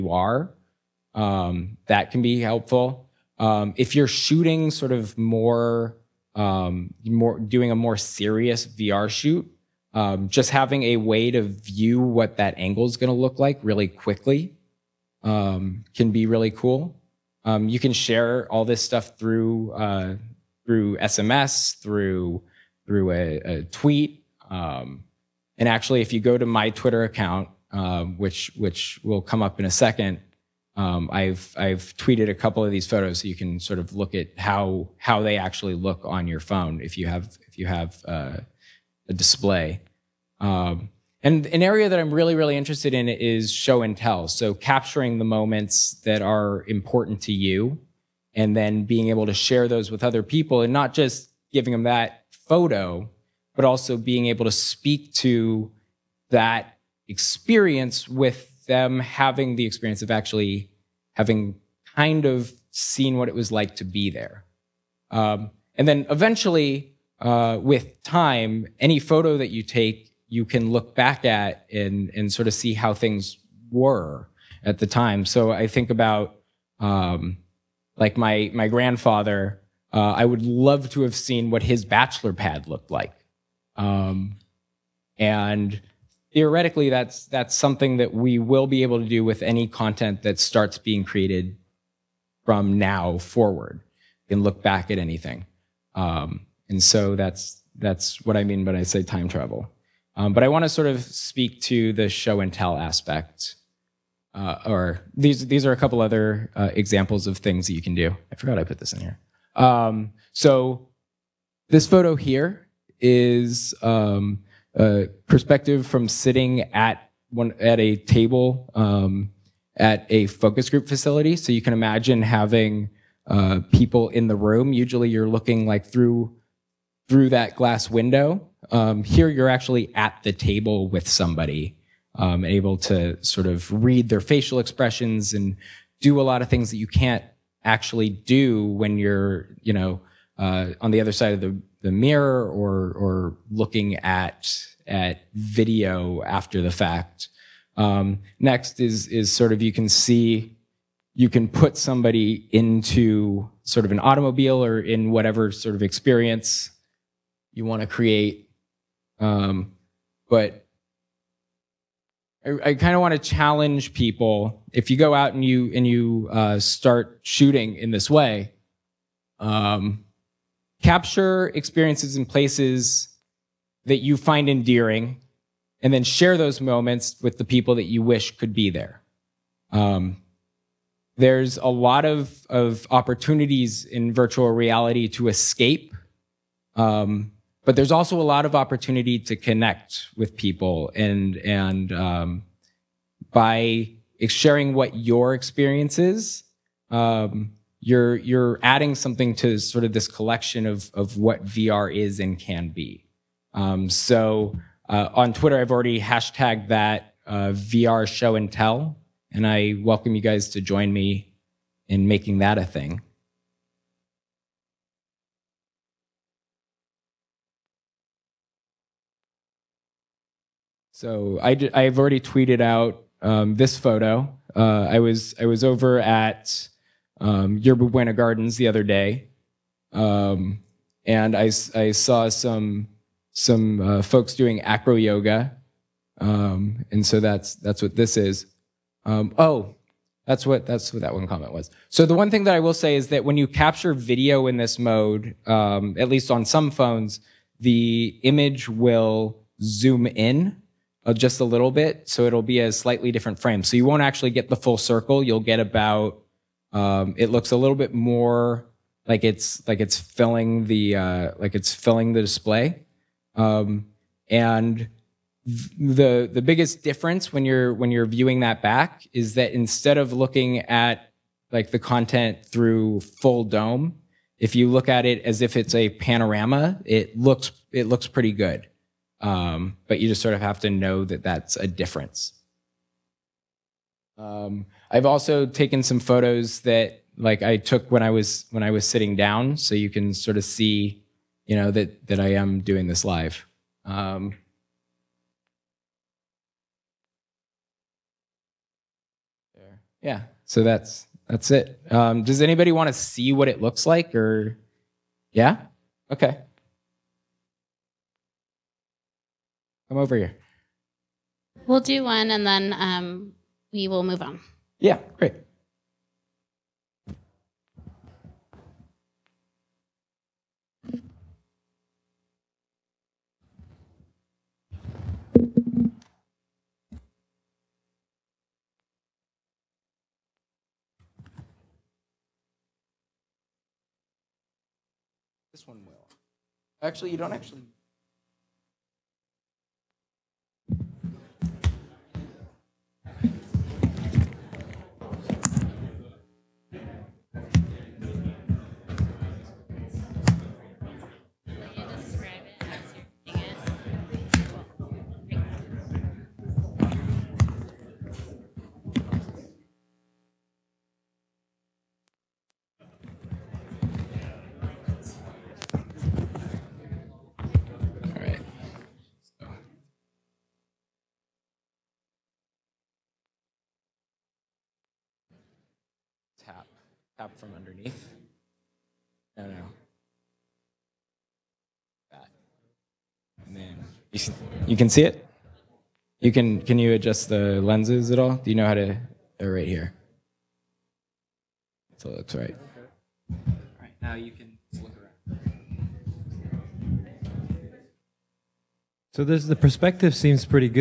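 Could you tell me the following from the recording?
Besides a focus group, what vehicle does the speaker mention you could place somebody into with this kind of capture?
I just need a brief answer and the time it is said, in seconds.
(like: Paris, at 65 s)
automobile, at 153 s.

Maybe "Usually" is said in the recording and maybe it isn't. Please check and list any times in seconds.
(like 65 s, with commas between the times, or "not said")
124 s.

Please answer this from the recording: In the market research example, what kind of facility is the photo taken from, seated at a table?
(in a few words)
focus group facility.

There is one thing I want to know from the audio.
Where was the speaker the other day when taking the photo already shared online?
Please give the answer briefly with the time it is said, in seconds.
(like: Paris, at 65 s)
Yerba Buena Gardens, at 227 s.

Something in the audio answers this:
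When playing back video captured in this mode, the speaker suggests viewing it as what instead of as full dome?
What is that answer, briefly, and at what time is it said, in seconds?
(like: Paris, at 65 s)
a panorama, at 275 s.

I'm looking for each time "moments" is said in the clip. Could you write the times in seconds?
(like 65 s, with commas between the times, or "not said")
45 s, 176 s.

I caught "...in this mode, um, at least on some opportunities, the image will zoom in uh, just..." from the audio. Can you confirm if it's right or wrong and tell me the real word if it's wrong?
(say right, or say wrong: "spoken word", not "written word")
wrong: "phones", not "opportunities".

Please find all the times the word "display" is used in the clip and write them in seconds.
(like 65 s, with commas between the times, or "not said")
39 s, 262 s.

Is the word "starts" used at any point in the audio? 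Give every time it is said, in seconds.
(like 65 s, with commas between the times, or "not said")
90 s, 166 s.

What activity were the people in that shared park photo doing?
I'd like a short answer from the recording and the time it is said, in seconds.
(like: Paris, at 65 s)
acro yoga, at 234 s.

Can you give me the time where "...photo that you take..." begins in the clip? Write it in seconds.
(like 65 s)
68 s.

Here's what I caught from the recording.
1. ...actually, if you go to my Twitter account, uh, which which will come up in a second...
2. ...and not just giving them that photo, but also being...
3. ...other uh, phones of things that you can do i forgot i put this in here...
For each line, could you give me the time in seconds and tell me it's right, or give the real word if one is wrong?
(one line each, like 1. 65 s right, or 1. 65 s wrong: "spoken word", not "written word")
1. 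25 s right
2. 50 s right
3. 106 s wrong: "examples", not "phones".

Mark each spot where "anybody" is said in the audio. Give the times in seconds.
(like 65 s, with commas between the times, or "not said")
302 s.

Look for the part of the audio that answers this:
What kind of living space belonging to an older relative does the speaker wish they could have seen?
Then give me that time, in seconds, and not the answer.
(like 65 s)
81 s.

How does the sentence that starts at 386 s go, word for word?
You can can you adjust the lenses at all?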